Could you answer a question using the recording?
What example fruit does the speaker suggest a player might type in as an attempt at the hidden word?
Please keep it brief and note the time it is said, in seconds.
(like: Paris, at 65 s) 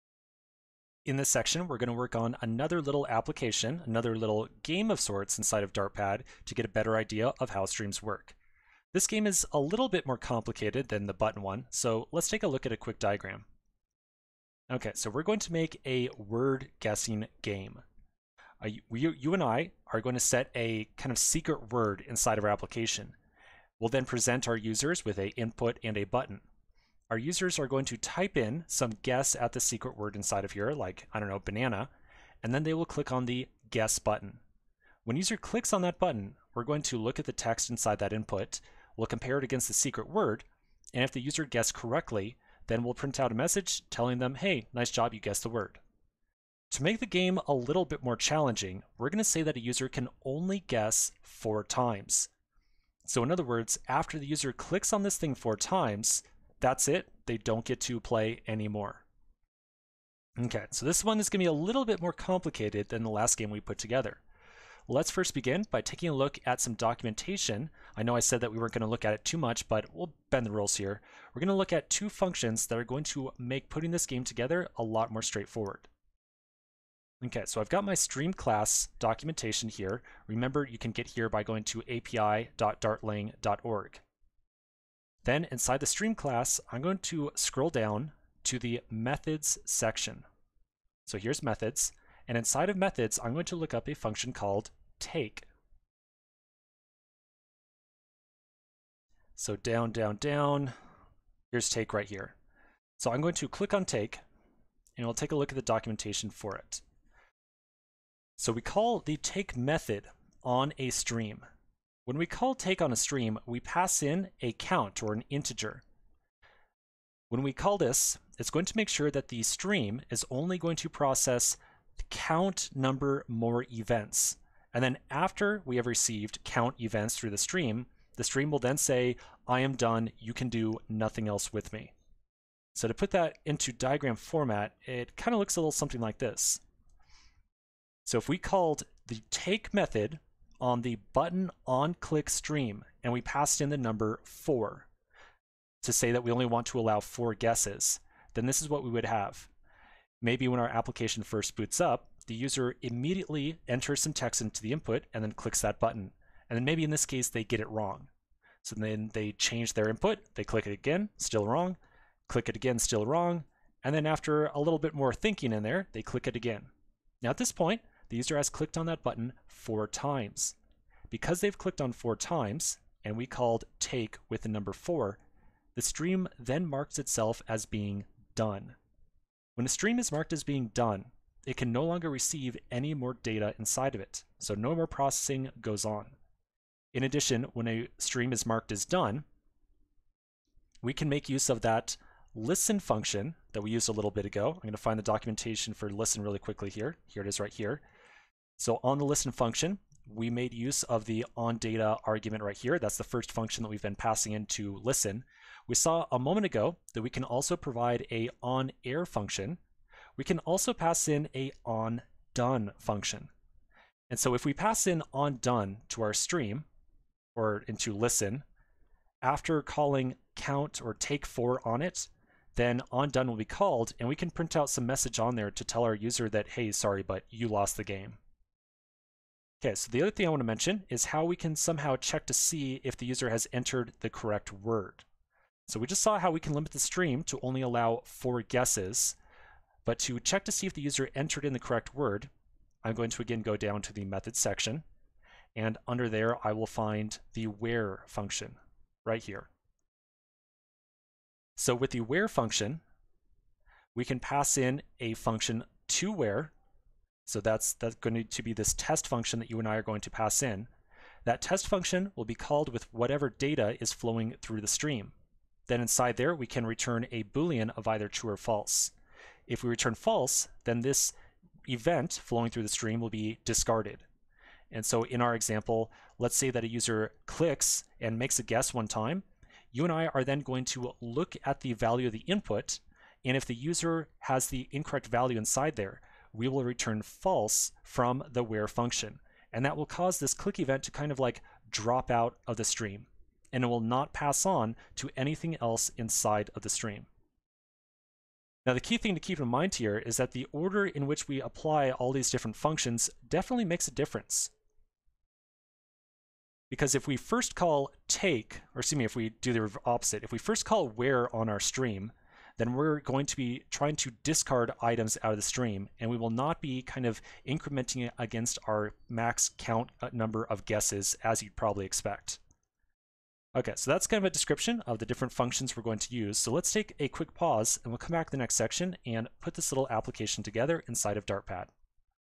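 banana, at 31 s.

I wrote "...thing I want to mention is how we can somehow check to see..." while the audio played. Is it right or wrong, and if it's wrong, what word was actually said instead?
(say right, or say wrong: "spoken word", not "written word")
right.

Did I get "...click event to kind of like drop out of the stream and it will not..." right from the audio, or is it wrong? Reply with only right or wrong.
right.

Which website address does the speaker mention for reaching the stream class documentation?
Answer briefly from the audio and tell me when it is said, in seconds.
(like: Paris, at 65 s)
api.dartlang.org, at 81 s.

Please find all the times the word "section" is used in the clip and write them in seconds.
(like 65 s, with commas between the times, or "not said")
1 s, 89 s, 244 s, 328 s.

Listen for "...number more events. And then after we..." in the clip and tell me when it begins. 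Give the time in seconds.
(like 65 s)
122 s.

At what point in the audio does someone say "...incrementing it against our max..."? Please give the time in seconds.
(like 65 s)
317 s.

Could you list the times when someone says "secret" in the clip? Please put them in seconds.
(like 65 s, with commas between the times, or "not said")
21 s, 29 s, 39 s.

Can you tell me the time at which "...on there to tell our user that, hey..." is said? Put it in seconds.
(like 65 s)
225 s.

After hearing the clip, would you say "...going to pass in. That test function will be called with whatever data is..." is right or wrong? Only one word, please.
right.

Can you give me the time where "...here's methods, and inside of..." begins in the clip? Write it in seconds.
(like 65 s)
91 s.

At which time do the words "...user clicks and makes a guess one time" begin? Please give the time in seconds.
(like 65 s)
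276 s.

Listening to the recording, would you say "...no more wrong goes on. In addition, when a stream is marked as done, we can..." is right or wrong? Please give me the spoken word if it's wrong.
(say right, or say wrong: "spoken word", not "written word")
wrong: "processing", not "wrong".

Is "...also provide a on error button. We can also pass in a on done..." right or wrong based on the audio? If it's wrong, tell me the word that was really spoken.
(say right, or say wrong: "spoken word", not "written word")
wrong: "function", not "button".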